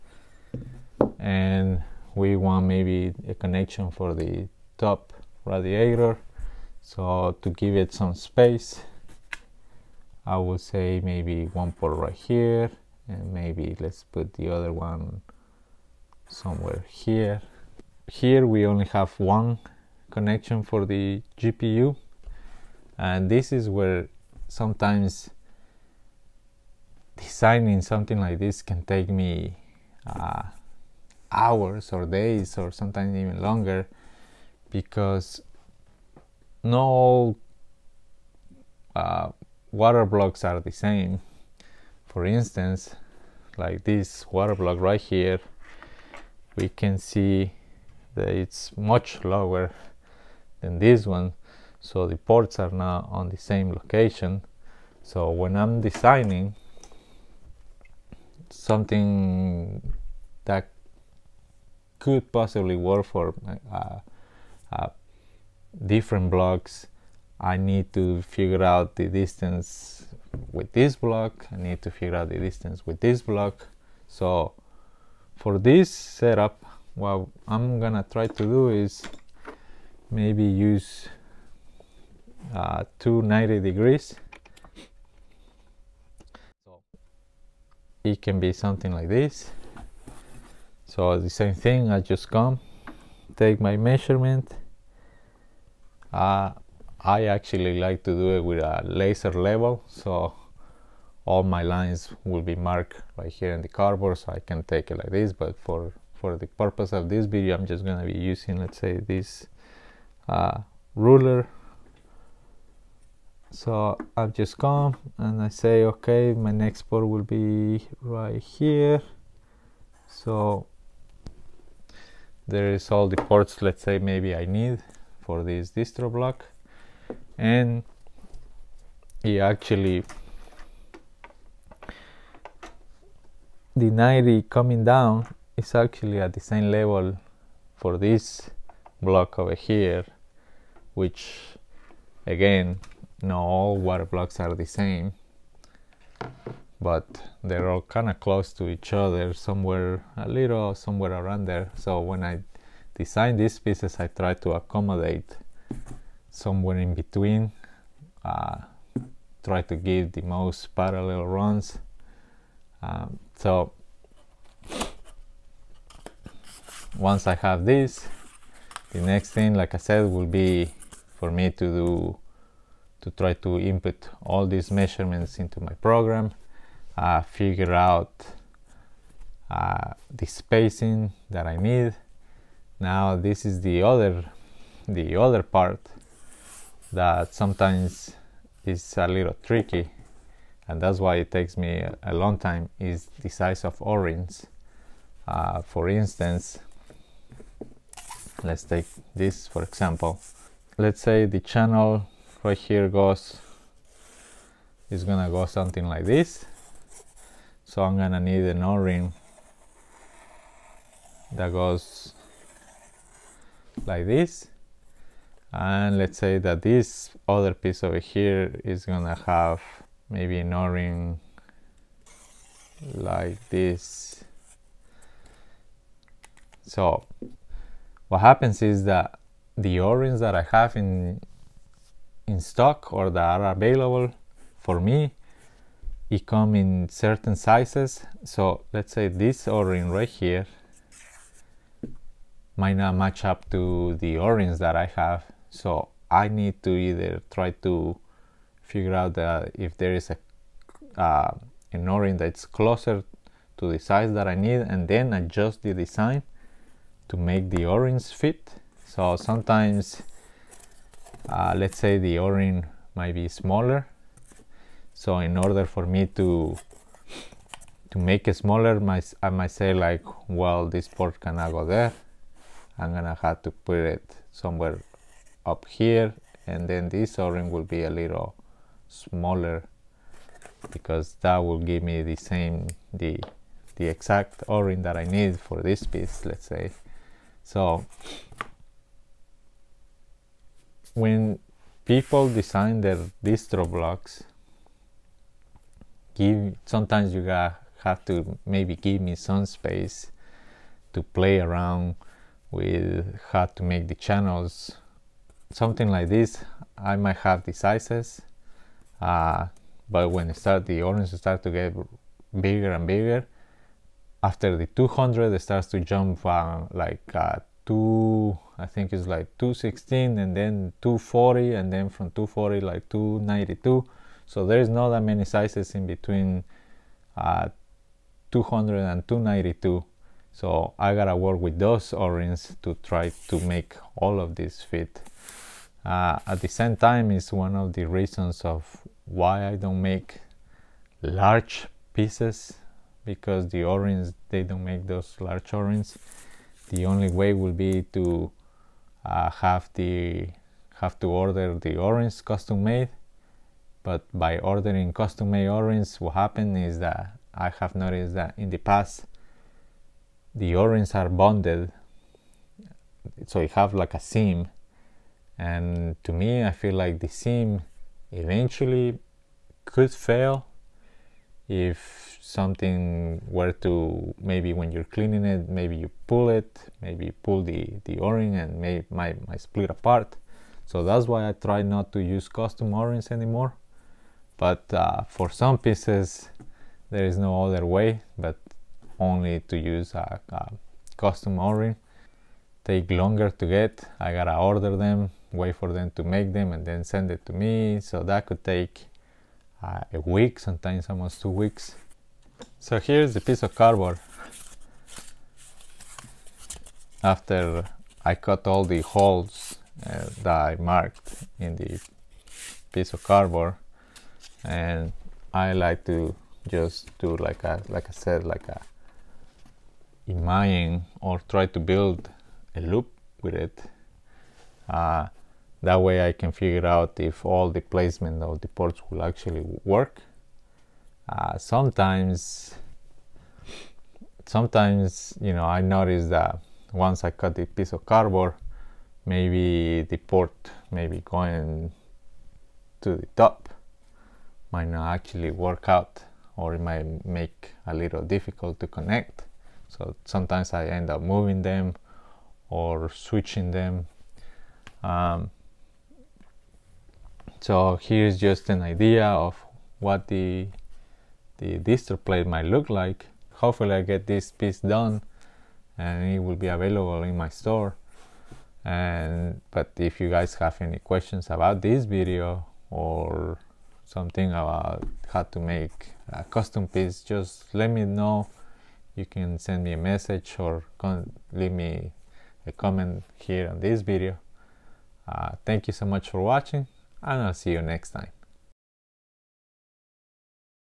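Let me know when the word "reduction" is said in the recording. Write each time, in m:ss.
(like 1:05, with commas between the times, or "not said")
not said.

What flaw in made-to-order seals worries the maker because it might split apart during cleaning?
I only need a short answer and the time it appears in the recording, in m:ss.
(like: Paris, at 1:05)
a seam, at 6:03.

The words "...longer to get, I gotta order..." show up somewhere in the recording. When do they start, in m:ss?
6:32.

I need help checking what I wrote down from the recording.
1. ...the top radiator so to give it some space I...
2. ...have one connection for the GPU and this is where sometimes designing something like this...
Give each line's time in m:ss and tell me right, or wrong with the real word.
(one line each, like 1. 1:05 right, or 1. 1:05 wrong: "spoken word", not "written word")
1. 0:04 right
2. 0:18 right.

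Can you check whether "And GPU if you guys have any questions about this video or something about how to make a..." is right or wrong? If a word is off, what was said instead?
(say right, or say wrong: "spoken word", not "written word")
wrong: "But", not "GPU".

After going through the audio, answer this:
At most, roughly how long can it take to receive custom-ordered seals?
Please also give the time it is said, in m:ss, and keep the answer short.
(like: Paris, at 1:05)
almost 2 weeks, at 6:40.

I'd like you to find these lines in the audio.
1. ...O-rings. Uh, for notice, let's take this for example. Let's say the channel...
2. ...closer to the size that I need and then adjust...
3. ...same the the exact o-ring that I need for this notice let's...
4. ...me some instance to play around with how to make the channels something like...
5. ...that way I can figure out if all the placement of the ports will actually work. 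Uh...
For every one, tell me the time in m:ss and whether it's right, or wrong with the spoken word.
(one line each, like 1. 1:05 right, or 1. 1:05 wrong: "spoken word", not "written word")
1. 3:13 wrong: "instance", not "notice"
2. 4:12 right
3. 4:42 wrong: "piece", not "notice"
4. 4:59 wrong: "space", not "instance"
5. 7:05 right.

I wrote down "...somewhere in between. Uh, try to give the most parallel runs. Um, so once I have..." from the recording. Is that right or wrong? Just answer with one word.
right.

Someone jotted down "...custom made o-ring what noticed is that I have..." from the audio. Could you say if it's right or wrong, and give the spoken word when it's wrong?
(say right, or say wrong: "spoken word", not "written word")
wrong: "happened", not "noticed".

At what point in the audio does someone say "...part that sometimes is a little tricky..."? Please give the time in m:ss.
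3:05.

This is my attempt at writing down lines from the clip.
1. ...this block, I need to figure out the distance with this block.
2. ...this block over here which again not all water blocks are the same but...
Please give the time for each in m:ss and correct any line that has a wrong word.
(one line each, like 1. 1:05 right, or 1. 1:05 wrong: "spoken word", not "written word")
1. 1:10 right
2. 2:17 right.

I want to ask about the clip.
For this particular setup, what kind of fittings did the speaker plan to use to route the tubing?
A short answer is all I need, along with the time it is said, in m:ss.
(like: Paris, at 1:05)
2 90 degree fittings, at 1:22.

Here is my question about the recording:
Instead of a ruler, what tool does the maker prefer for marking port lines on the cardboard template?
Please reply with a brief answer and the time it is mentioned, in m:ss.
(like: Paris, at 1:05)
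laser level, at 1:38.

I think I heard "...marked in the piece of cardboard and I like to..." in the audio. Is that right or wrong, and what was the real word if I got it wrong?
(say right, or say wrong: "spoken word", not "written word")
right.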